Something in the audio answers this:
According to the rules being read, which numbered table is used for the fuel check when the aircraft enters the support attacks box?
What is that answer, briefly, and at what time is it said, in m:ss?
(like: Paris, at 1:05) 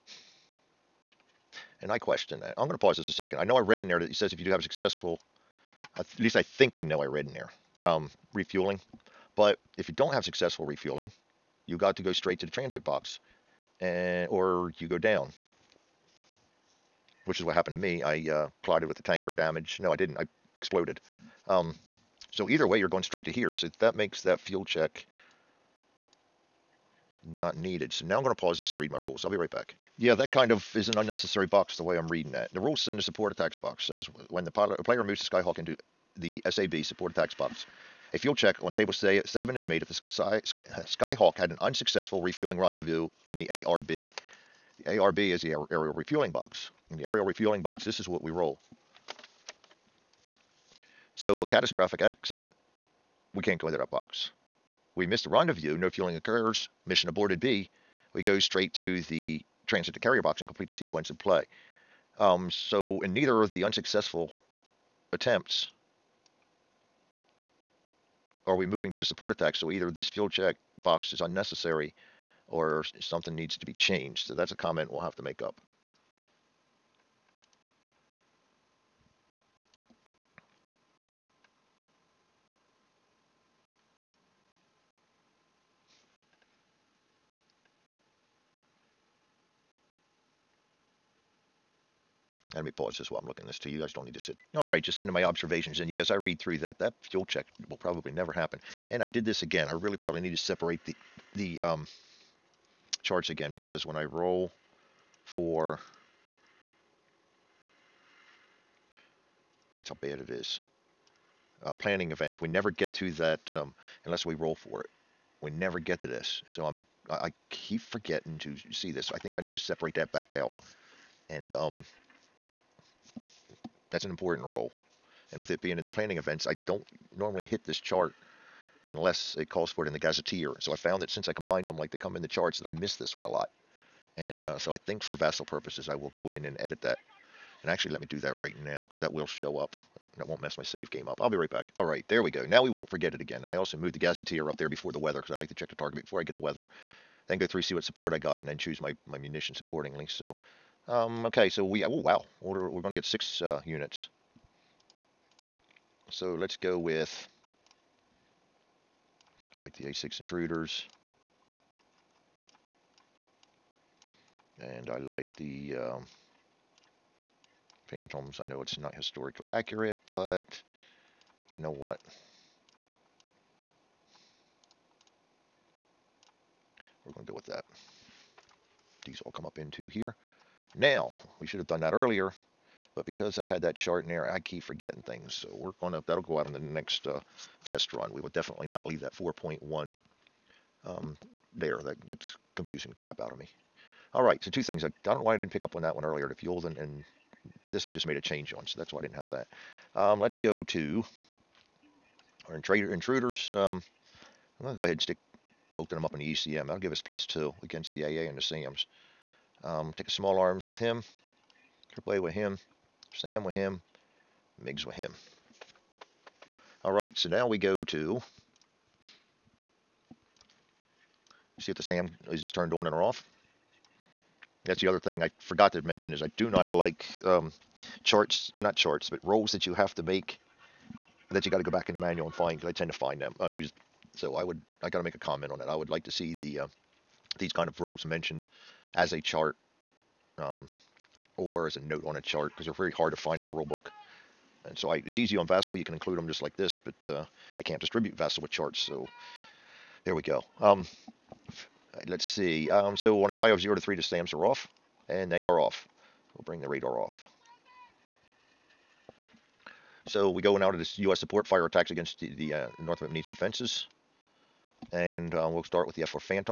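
Table 7, at 0:38.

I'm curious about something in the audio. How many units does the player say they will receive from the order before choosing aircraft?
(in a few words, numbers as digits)
6.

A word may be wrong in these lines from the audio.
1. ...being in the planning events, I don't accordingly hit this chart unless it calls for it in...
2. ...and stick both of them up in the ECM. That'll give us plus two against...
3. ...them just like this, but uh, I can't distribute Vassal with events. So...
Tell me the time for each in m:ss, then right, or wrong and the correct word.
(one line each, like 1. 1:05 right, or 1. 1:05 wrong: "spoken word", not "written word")
1. 2:05 wrong: "normally", not "accordingly"
2. 3:24 right
3. 4:06 wrong: "charts", not "events".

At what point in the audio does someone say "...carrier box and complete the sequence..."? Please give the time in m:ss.
0:59.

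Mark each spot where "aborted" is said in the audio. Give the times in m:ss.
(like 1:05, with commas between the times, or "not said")
0:57.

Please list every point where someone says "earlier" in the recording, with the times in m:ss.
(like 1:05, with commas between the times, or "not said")
3:01, 3:16.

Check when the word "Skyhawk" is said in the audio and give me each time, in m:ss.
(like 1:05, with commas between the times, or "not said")
0:35, 0:40.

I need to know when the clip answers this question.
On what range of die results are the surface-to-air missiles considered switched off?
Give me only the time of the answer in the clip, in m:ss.
4:13.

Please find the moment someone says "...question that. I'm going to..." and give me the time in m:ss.
0:01.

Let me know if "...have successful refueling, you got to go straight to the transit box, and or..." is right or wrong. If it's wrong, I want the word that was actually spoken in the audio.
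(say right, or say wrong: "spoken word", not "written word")
right.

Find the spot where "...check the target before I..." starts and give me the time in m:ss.
2:25.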